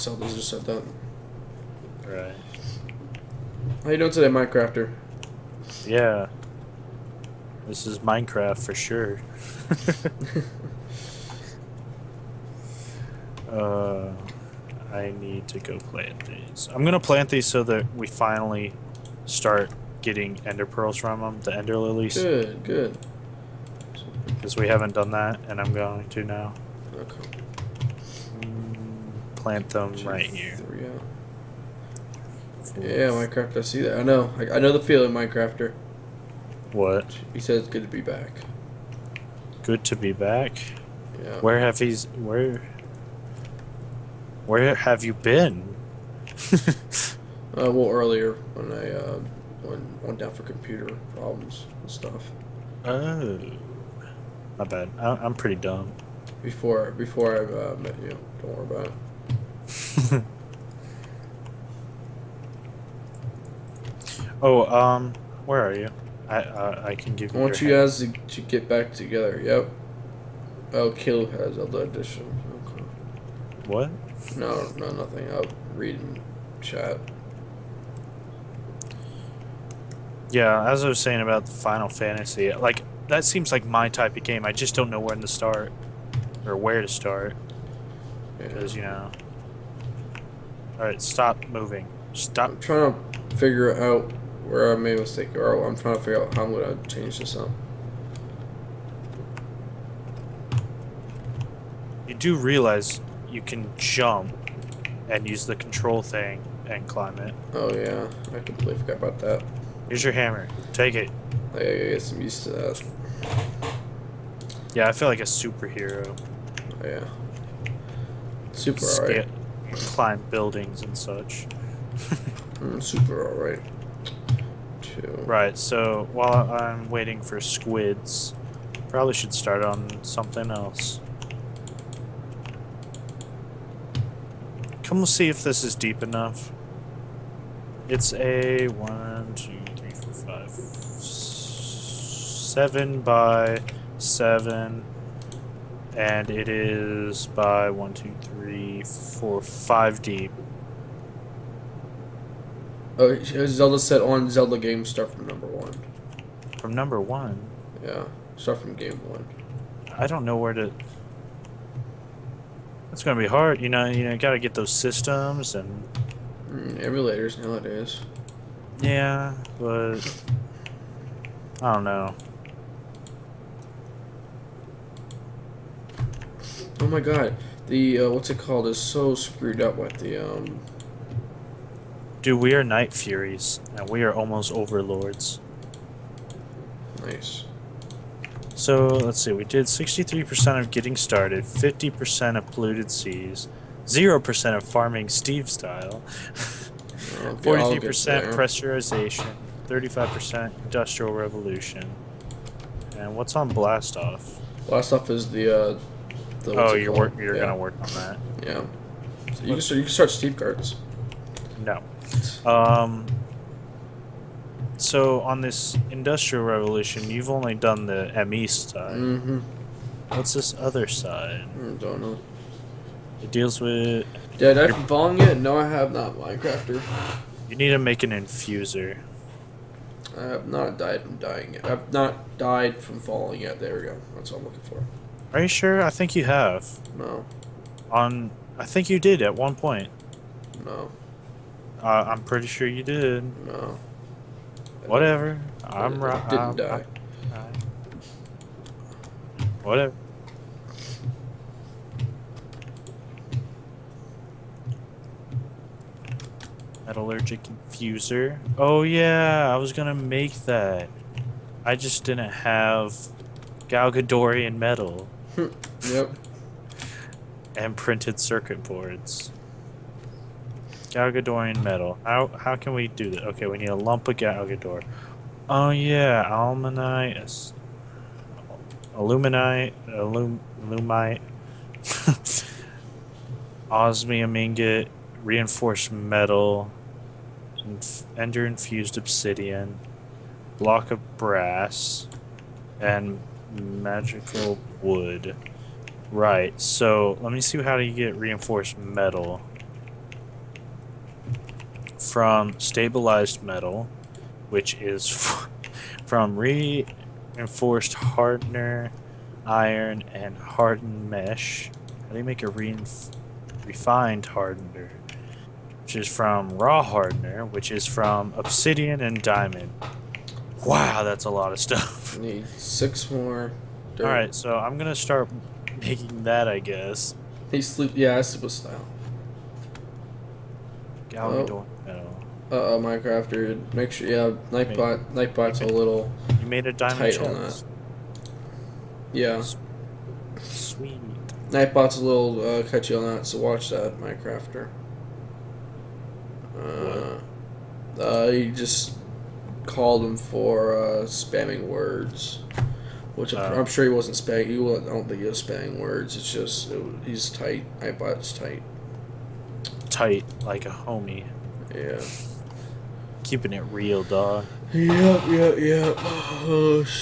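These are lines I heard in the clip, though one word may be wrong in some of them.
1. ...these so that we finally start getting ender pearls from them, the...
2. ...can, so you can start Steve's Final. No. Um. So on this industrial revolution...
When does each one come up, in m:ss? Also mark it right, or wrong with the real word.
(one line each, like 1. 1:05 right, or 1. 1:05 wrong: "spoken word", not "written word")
1. 0:17 right
2. 3:29 wrong: "Carts", not "Final".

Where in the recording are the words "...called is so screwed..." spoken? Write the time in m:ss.
2:58.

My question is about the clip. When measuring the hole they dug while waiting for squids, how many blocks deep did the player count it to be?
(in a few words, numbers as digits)
5.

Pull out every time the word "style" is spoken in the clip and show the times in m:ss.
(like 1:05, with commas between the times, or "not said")
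3:15, 5:28.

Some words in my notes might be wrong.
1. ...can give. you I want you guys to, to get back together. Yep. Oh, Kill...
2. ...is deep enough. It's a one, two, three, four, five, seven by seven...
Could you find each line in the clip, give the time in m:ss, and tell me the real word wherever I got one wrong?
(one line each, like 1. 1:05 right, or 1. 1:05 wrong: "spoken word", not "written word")
1. 1:06 right
2. 2:15 right.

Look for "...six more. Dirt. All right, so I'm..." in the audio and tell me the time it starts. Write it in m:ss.
5:22.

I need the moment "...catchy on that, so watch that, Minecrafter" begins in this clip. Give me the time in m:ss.
5:42.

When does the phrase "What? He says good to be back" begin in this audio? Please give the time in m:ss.
0:36.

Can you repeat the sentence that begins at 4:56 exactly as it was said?
Right, so let me see how do you get reinforced metal.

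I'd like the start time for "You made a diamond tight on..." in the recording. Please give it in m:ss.
5:36.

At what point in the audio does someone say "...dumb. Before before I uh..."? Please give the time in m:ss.
0:55.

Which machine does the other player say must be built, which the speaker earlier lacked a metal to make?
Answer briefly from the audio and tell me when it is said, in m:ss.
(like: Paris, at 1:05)
Metallurgic infuser, at 4:16.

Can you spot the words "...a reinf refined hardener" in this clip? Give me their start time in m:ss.
5:12.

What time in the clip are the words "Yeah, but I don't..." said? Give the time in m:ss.
2:48.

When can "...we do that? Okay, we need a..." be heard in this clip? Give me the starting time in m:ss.
4:32.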